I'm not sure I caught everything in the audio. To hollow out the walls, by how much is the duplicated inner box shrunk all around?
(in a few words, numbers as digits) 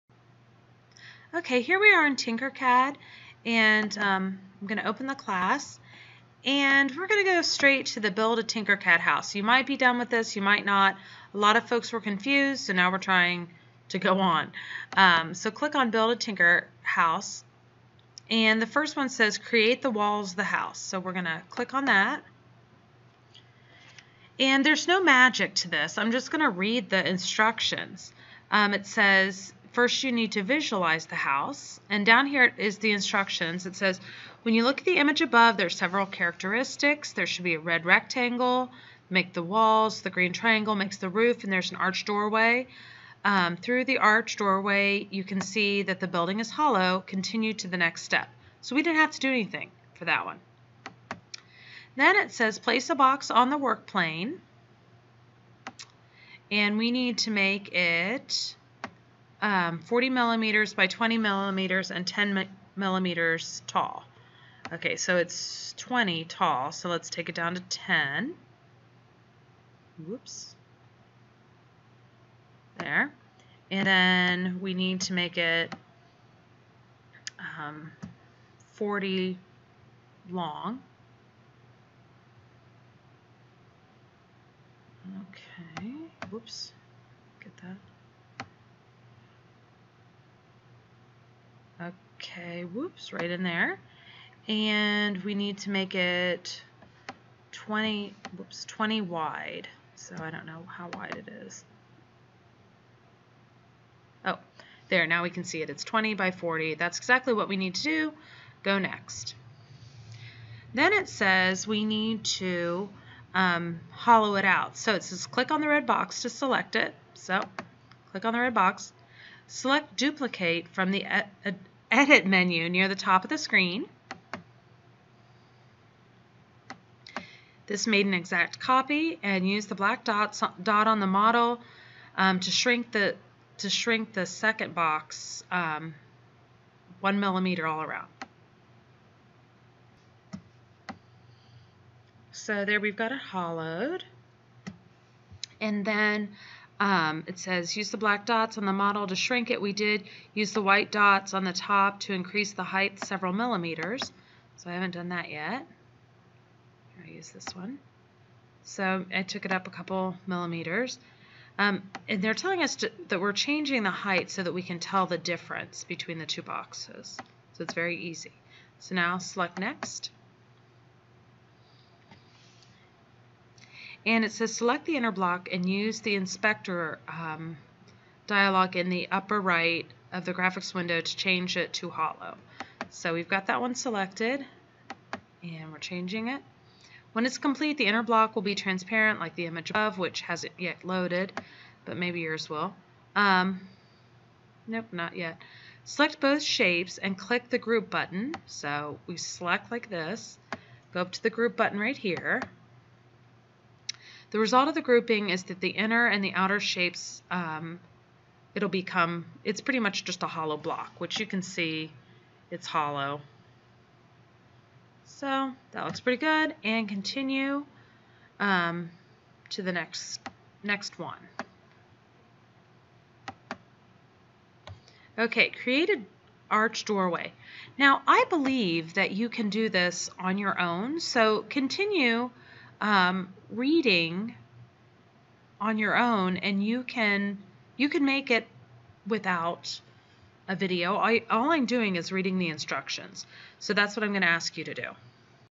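1 millimeter.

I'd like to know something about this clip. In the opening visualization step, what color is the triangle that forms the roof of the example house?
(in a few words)
green.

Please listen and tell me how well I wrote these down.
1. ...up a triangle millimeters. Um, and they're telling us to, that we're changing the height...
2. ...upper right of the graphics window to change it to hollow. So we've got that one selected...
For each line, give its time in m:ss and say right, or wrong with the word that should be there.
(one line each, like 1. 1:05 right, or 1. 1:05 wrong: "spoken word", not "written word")
1. 2:39 wrong: "couple", not "triangle"
2. 2:59 right.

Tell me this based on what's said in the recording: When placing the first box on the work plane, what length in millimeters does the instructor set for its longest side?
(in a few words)
40.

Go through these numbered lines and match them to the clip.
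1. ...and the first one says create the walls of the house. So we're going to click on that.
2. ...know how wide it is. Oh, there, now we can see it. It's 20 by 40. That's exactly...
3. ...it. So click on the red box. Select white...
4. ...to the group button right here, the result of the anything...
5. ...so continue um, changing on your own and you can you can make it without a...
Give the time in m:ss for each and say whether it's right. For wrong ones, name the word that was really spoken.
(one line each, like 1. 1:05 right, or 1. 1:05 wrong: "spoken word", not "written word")
1. 0:18 right
2. 1:40 right
3. 1:56 wrong: "duplicate", not "white"
4. 3:21 wrong: "grouping", not "anything"
5. 3:51 wrong: "reading", not "changing".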